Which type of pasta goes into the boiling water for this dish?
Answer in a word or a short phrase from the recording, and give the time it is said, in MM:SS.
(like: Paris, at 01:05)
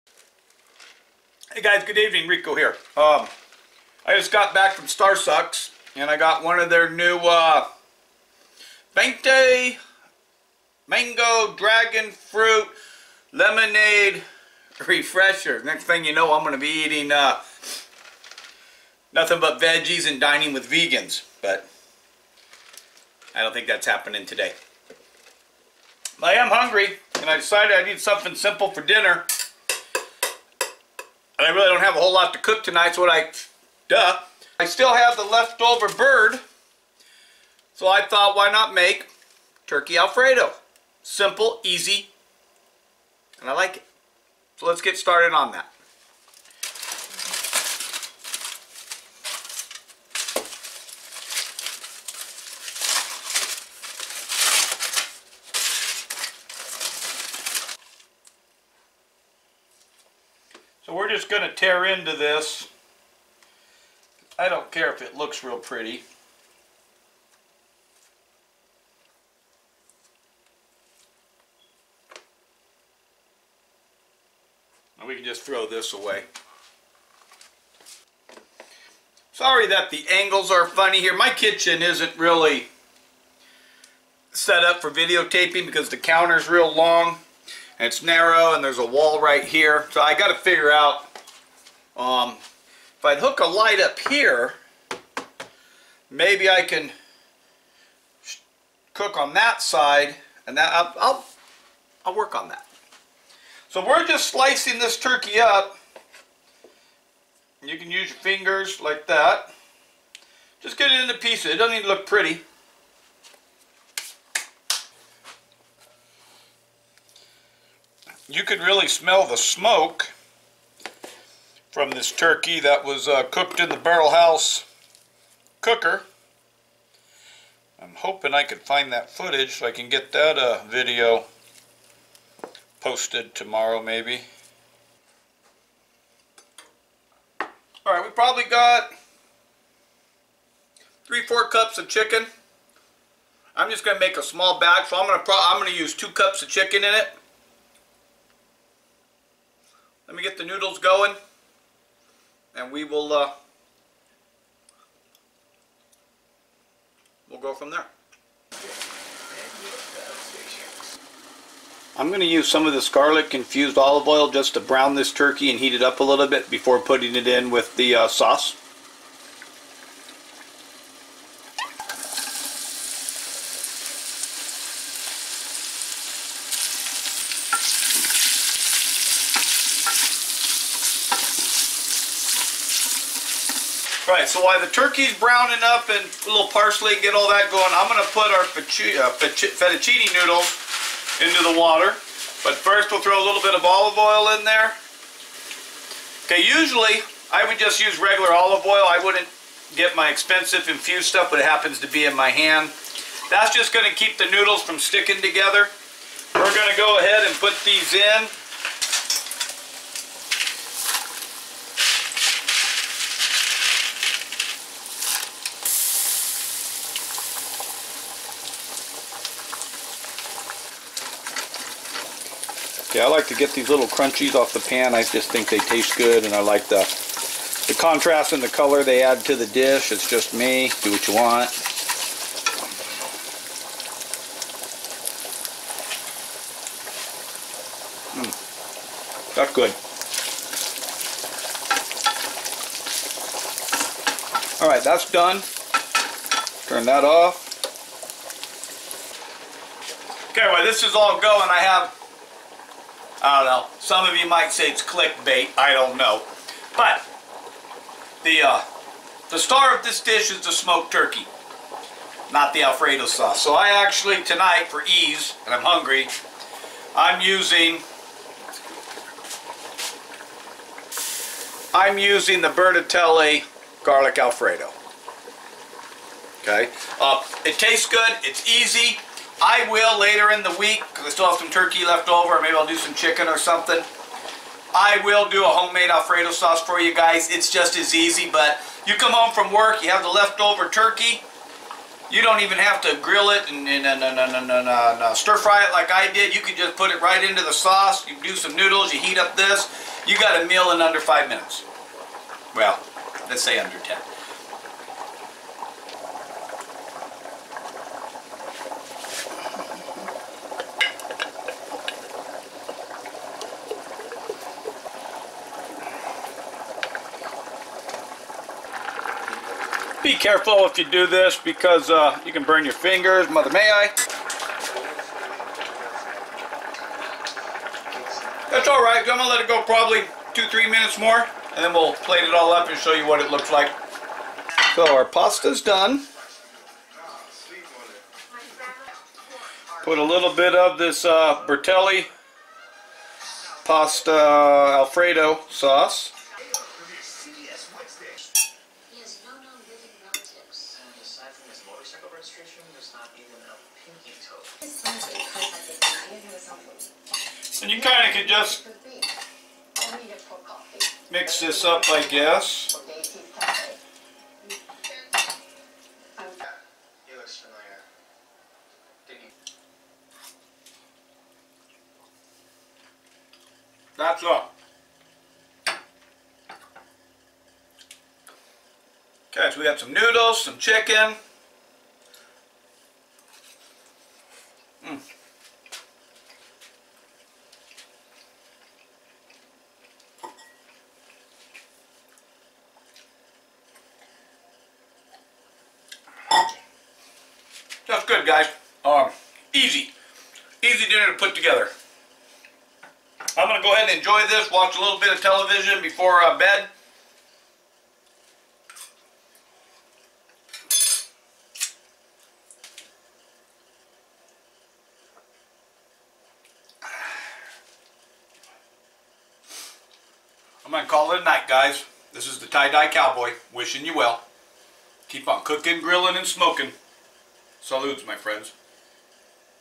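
fettuccine, at 03:09.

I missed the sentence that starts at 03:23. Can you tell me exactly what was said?
That's just going to keep the noodles from sticking together.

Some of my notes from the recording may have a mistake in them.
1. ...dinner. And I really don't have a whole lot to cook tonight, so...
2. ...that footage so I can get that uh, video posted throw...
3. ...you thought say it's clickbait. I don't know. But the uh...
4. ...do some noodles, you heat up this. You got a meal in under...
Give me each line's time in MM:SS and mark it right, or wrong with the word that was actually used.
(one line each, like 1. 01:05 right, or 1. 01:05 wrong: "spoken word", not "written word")
1. 00:28 right
2. 02:08 wrong: "tomorrow", not "throw"
3. 04:14 wrong: "might", not "thought"
4. 04:58 right.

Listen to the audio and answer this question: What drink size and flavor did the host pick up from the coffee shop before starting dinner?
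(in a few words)
Venti Mango Dragon Fruit Lemonade.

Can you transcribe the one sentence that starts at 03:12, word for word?
But first we'll throw a little bit of olive oil in there.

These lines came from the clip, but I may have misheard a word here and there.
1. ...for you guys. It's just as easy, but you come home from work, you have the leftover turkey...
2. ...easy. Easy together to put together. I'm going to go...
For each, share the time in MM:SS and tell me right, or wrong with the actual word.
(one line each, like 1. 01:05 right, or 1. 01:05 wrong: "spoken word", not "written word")
1. 04:46 right
2. 06:39 wrong: "dinner", not "together".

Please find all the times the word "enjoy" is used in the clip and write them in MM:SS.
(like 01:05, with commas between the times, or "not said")
06:43.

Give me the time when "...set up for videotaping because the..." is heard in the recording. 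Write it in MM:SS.
01:24.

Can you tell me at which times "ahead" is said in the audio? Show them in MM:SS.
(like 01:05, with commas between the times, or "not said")
03:26, 06:43.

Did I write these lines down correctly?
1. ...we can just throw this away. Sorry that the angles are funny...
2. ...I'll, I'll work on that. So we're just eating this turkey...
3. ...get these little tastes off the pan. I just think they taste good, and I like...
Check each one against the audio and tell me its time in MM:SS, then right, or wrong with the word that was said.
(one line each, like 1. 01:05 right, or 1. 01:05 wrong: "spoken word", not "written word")
1. 01:15 right
2. 01:41 wrong: "slicing", not "eating"
3. 03:43 wrong: "crunchies", not "tastes".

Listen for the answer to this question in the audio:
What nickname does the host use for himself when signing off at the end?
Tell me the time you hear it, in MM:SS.
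07:02.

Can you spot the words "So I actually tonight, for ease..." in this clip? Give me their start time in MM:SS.
04:23.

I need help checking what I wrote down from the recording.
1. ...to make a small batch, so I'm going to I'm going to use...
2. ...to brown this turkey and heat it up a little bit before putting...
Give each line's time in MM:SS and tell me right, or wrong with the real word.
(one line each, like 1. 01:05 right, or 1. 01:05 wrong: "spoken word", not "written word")
1. 02:23 right
2. 02:44 right.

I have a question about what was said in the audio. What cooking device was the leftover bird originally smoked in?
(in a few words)
barrel house cooker.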